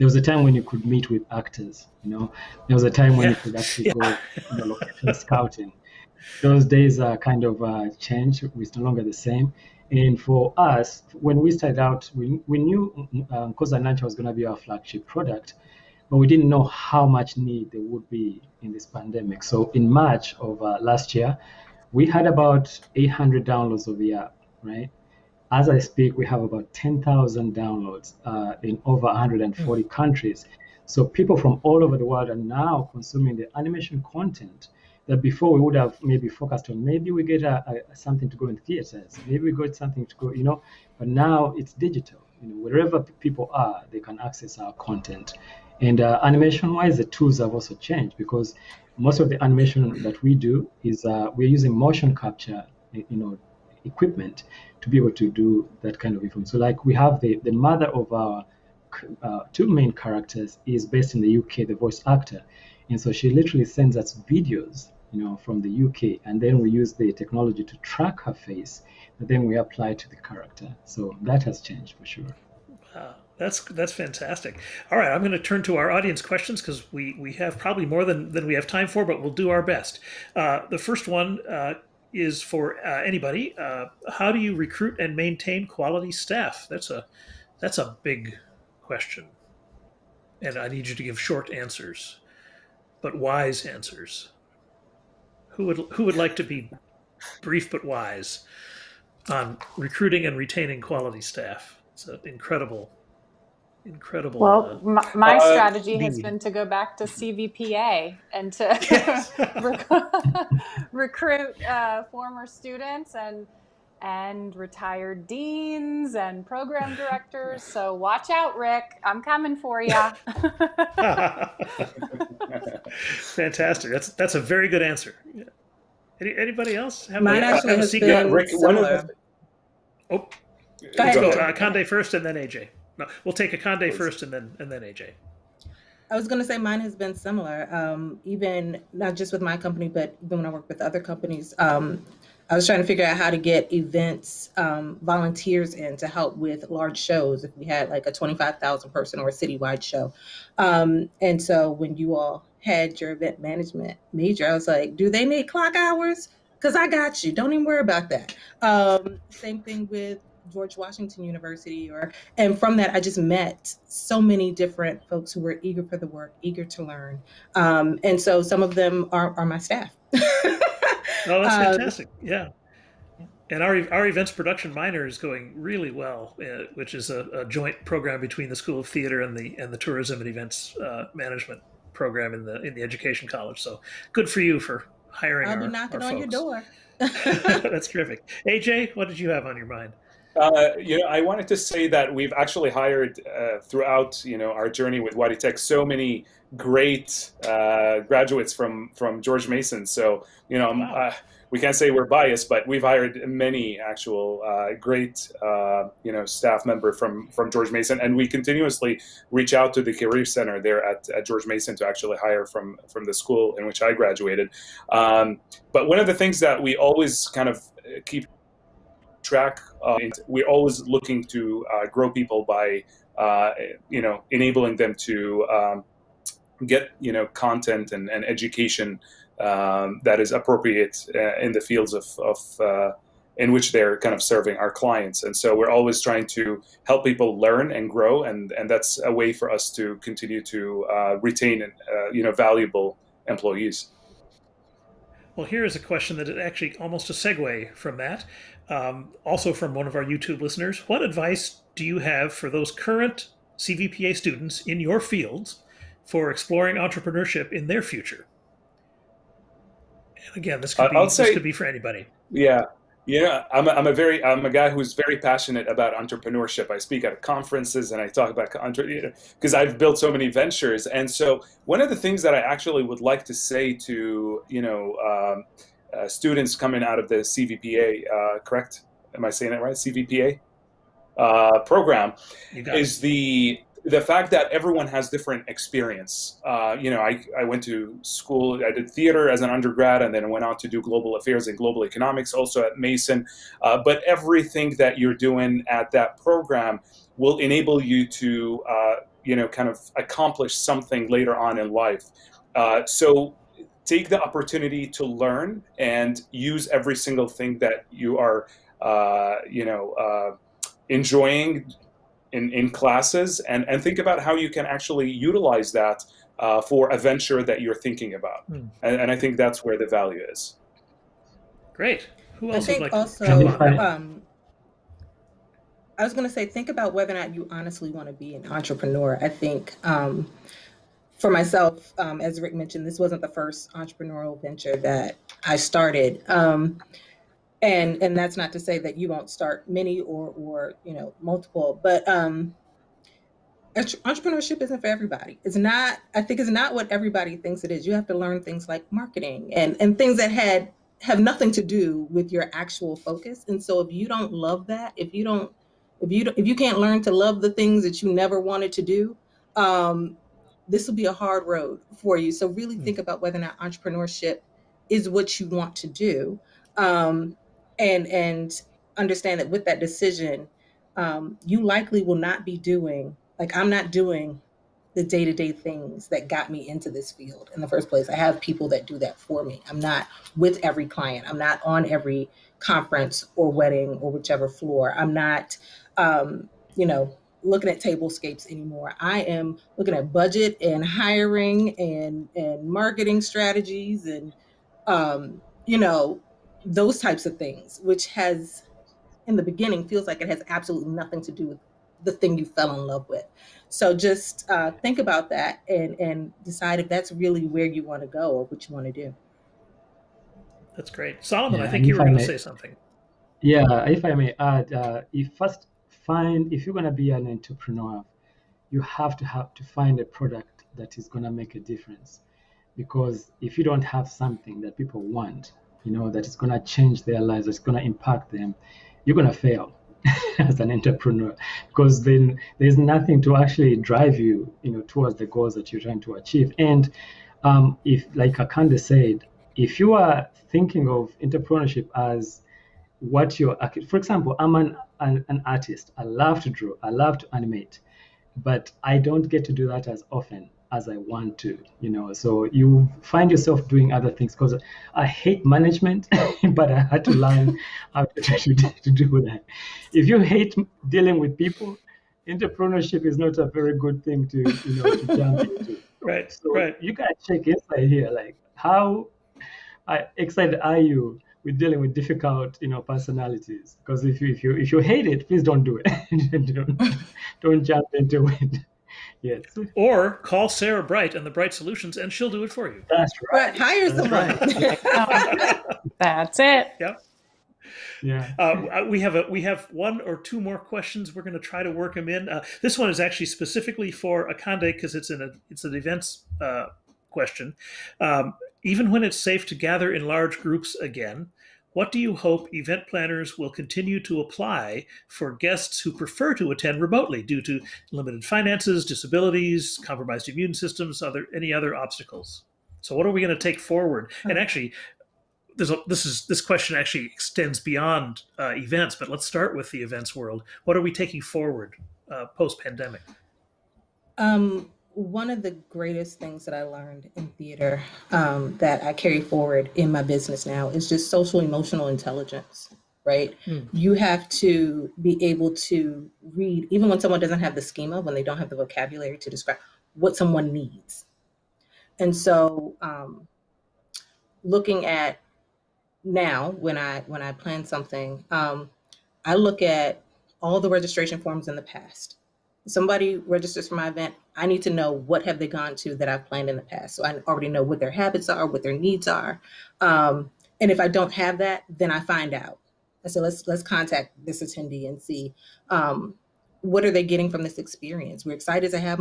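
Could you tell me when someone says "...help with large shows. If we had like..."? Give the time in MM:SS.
02:26.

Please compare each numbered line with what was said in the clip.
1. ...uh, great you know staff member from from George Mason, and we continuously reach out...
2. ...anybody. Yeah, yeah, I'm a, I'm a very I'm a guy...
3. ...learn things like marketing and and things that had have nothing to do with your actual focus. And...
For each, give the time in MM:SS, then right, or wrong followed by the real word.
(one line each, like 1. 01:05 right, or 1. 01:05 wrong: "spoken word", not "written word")
1. 03:24 right
2. 04:21 right
3. 05:48 right.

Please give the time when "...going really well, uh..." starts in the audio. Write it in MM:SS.
02:55.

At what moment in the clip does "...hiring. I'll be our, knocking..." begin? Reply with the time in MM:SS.
03:05.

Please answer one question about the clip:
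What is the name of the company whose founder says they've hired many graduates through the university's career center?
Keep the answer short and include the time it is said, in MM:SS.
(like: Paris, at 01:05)
WadiTek, at 03:15.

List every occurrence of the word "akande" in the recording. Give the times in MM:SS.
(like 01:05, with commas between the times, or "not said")
02:13, 07:18, 08:14.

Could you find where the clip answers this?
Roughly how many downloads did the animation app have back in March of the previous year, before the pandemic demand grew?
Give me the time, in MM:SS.
00:22.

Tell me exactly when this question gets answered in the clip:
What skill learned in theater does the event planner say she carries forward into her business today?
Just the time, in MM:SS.
08:51.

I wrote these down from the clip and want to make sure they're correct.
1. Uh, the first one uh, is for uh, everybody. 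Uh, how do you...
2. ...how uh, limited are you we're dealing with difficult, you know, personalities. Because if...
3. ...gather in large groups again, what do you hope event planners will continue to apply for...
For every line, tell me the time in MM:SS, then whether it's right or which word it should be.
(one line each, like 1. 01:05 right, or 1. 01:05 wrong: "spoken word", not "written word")
1. 01:20 wrong: "anybody", not "everybody"
2. 07:48 wrong: "excited", not "limited"
3. 08:19 right.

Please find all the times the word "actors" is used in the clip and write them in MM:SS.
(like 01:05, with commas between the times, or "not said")
00:01, 01:02.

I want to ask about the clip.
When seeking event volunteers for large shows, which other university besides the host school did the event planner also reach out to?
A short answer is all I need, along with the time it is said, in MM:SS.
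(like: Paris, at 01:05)
George Washington University, at 02:40.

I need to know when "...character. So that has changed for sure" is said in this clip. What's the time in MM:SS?
01:10.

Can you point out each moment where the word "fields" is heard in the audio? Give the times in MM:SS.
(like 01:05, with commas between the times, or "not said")
03:51, 04:14, 06:17.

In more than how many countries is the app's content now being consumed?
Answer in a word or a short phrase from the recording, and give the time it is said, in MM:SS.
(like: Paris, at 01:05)
140, at 00:29.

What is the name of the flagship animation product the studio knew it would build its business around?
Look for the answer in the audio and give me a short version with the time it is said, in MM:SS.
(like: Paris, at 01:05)
Nankya, at 00:13.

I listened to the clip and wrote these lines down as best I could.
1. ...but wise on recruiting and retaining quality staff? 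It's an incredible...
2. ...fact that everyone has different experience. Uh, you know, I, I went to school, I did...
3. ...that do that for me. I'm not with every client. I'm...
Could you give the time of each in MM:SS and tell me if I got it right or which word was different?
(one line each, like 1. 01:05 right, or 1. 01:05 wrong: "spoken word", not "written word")
1. 01:37 right
2. 04:44 right
3. 06:18 right.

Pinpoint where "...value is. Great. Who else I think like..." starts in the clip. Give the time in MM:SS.
05:19.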